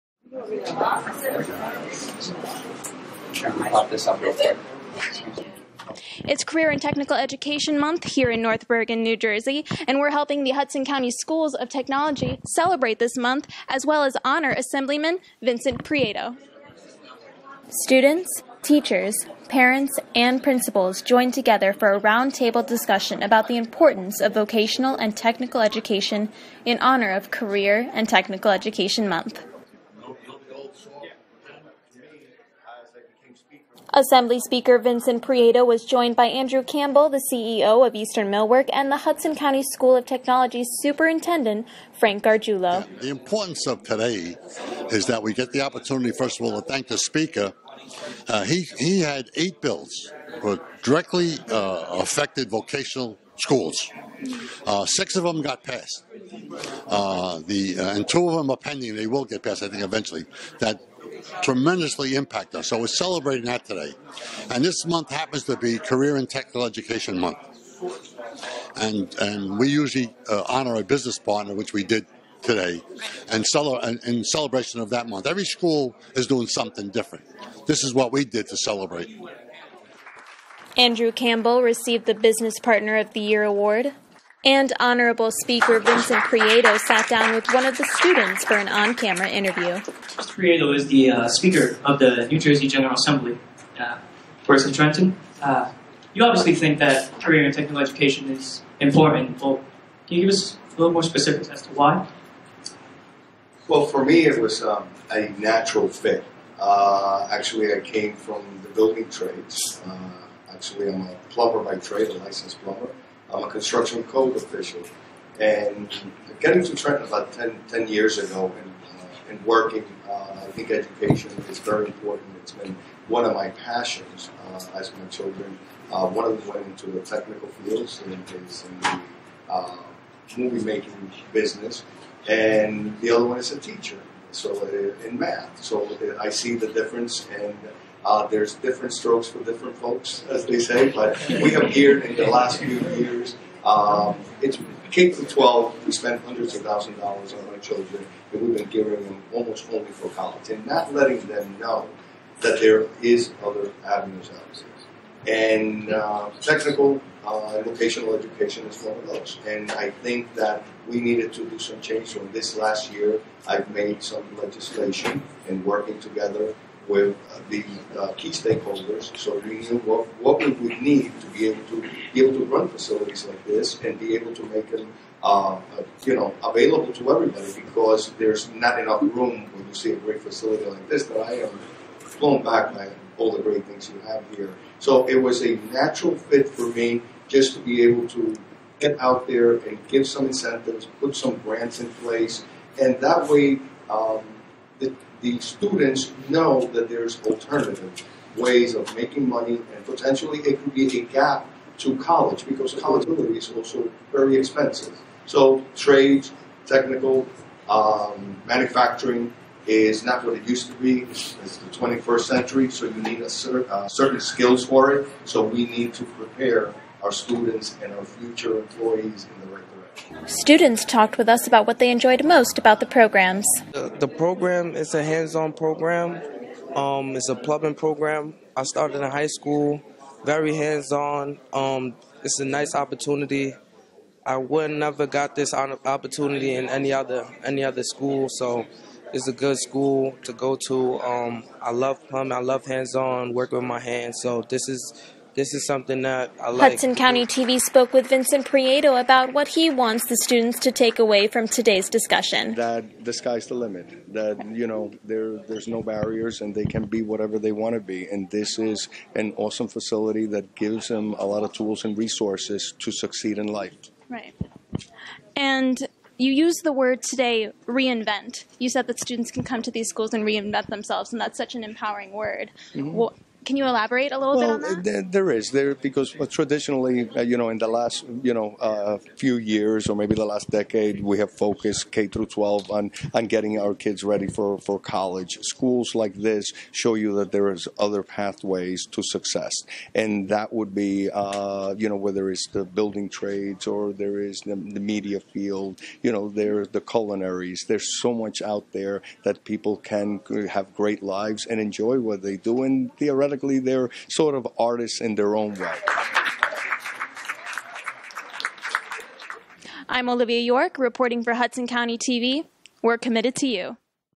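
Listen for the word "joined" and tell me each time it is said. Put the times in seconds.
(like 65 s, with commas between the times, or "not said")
21 s, 35 s.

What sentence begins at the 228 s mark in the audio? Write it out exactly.
I started in high school, very hands on.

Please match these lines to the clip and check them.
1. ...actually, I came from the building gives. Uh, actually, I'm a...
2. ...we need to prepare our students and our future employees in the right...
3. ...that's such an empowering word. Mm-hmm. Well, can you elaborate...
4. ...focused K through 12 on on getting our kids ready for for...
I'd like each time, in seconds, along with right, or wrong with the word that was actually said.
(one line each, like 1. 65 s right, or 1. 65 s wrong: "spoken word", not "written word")
1. 107 s wrong: "trades", not "gives"
2. 215 s right
3. 271 s right
4. 281 s right.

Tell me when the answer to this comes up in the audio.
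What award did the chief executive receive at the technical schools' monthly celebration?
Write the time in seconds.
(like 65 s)
82 s.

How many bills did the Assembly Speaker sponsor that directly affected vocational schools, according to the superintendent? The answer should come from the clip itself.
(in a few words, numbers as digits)
8.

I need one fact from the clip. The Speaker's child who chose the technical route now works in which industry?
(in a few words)
Movie making.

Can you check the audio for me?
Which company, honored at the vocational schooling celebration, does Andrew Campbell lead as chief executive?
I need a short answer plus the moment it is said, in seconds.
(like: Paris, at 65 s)
Eastern Millwork, at 37 s.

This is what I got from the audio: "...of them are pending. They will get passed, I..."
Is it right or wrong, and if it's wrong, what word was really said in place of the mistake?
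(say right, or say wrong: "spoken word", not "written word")
right.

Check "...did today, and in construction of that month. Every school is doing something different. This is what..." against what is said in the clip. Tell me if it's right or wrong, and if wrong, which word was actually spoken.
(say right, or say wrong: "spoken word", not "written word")
wrong: "celebration", not "construction".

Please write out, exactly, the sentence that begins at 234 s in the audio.
I would never got this opportunity in any other any other school, so it's a good school to go to.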